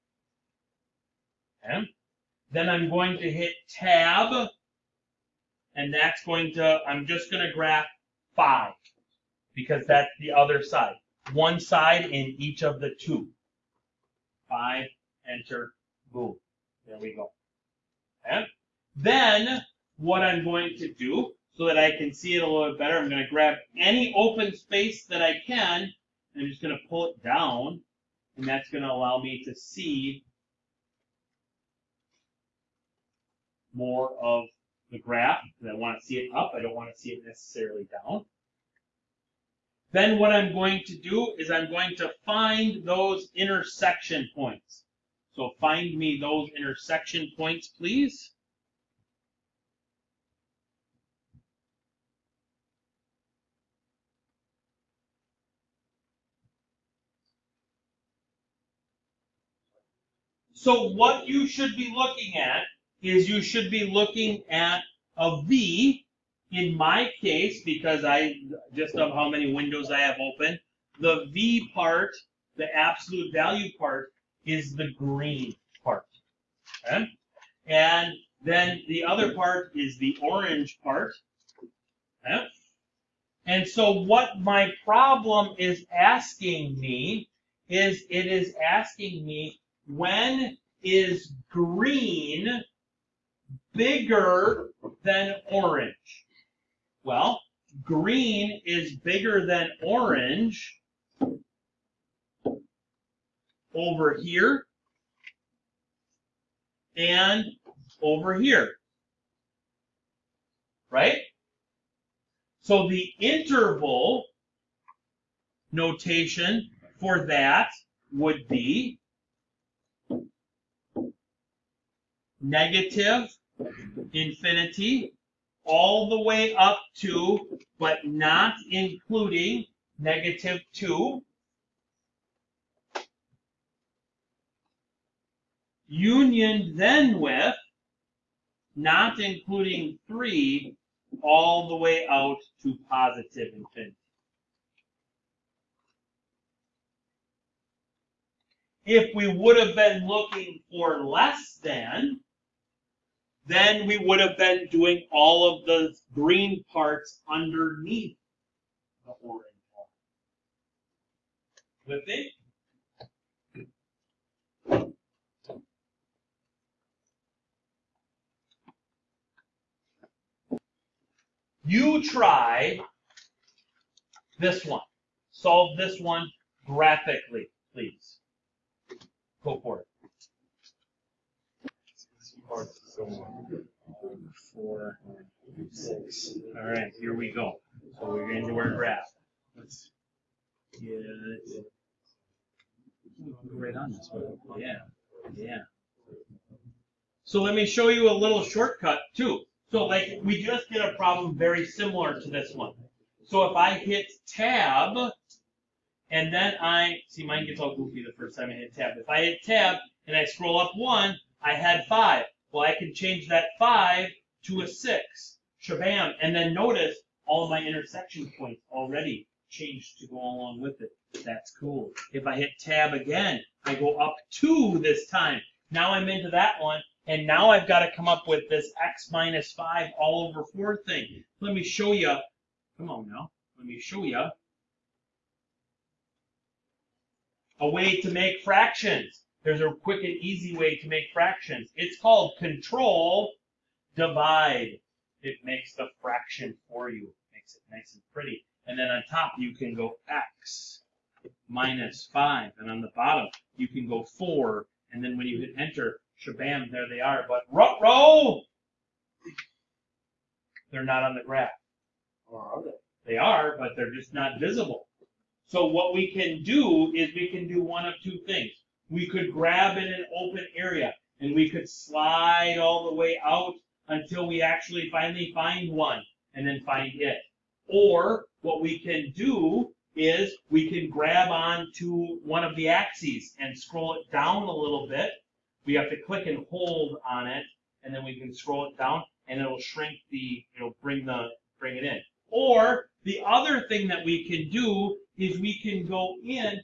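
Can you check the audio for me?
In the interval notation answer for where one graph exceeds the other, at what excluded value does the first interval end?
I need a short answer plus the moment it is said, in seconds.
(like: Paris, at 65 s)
-2, at 129 s.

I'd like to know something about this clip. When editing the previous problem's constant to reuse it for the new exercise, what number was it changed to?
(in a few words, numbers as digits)
6.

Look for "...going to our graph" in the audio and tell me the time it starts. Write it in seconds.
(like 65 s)
188 s.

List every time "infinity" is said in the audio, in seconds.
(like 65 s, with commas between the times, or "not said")
124 s, 143 s.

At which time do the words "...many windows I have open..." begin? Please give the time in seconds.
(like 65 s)
69 s.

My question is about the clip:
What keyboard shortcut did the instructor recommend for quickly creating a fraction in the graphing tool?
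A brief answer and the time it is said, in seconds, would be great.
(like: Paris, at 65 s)
Control divide, at 242 s.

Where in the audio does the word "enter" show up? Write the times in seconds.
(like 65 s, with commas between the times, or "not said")
15 s, 255 s.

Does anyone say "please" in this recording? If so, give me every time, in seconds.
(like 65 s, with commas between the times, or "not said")
47 s, 177 s.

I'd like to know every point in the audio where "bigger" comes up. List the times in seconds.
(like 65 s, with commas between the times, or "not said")
93 s, 98 s.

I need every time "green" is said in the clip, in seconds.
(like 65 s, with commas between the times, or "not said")
74 s, 91 s, 97 s, 156 s.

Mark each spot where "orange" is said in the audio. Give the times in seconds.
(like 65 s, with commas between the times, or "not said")
80 s, 95 s, 99 s, 159 s.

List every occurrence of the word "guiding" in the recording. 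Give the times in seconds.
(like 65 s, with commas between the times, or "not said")
not said.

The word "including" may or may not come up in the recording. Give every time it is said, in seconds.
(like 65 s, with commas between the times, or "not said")
128 s, 139 s.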